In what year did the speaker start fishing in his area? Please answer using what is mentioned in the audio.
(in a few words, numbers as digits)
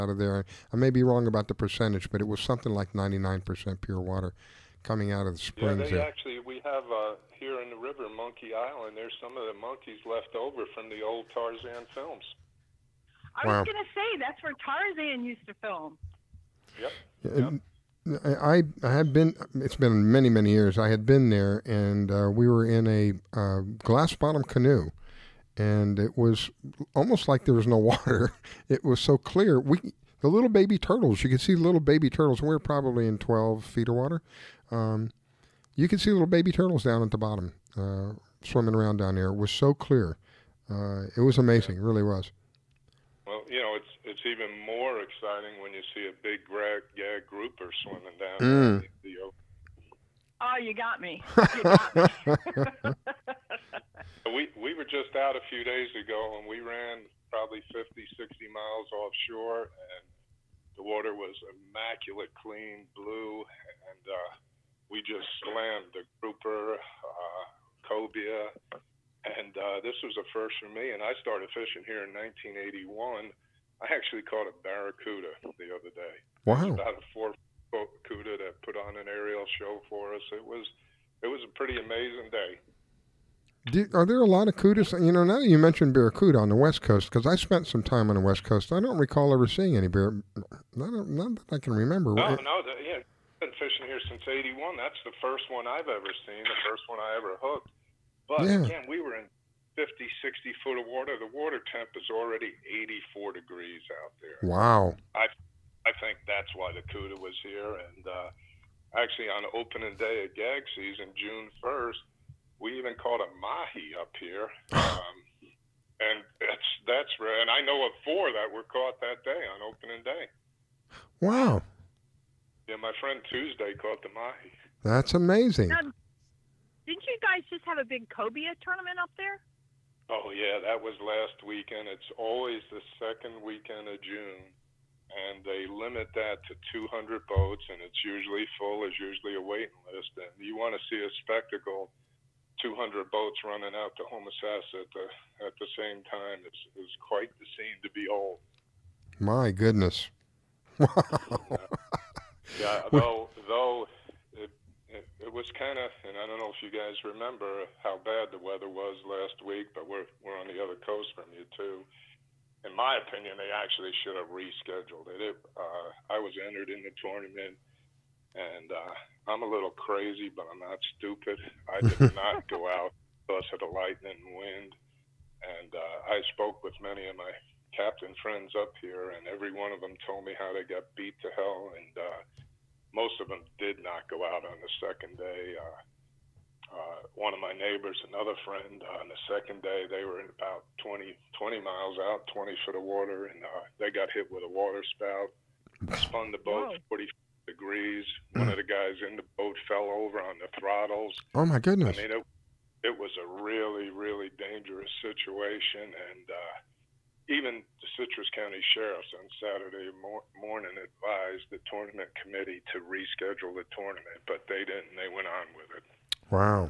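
1981.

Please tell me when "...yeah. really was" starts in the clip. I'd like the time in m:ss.
0:41.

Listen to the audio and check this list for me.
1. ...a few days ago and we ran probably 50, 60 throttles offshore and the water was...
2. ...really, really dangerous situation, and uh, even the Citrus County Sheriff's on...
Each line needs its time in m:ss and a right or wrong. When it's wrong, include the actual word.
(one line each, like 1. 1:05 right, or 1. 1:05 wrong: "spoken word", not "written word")
1. 0:55 wrong: "miles", not "throttles"
2. 3:23 right.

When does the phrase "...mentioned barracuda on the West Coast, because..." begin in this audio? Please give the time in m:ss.
1:25.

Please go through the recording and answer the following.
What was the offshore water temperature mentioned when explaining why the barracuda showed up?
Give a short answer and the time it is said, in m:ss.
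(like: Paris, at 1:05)
84 degrees, at 1:42.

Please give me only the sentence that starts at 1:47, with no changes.
And uh, actually, on opening day of gag season, June 1st, we even caught a mahi up here.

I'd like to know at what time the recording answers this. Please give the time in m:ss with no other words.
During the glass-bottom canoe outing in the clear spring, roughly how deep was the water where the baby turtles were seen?
0:33.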